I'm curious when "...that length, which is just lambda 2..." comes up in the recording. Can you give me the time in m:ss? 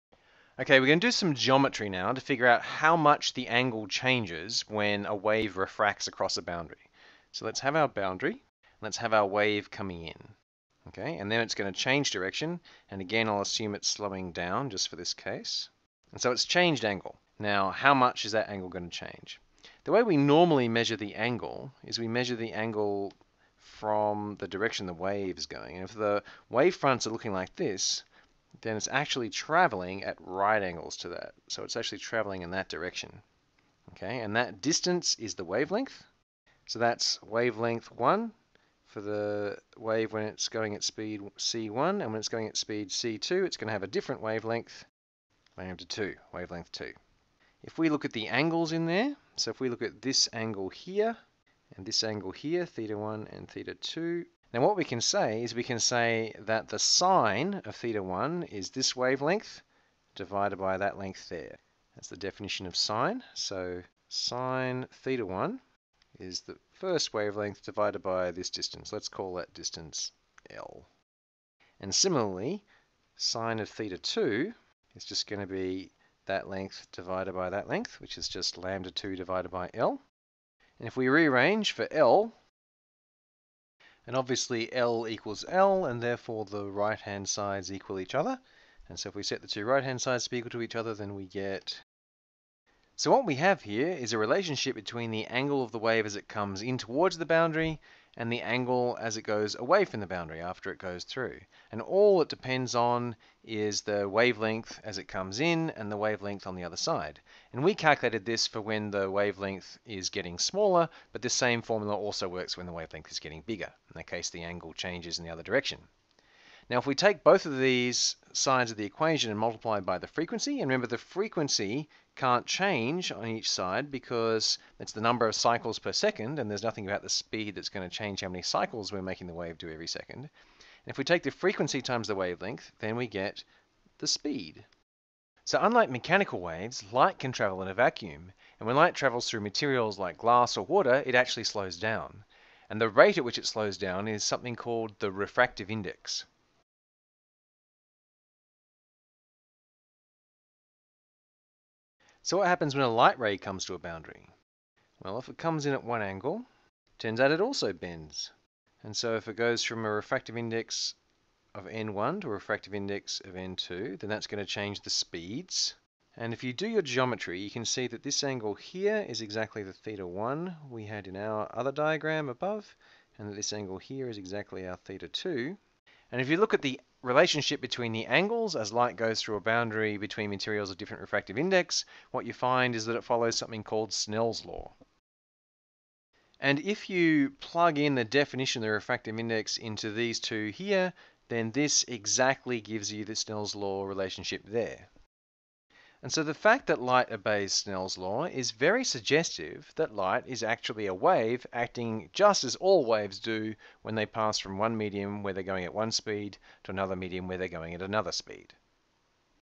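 1:17.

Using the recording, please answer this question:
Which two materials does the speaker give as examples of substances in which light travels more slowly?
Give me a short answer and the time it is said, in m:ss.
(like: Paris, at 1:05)
glass or water, at 2:20.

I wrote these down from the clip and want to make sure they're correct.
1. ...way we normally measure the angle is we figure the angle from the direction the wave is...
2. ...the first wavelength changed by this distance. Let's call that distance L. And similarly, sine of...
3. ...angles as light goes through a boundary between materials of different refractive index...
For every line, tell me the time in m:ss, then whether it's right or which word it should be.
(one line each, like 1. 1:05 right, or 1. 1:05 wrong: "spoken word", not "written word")
1. 0:19 wrong: "measure", not "figure"
2. 1:06 wrong: "divided", not "changed"
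3. 2:58 right.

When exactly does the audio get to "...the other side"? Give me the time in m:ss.
1:46.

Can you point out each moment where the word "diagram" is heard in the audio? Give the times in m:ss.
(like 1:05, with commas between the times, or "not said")
2:51.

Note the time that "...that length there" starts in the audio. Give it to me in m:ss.
1:00.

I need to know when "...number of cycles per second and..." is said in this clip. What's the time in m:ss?
2:05.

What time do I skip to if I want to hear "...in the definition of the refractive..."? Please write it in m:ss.
3:07.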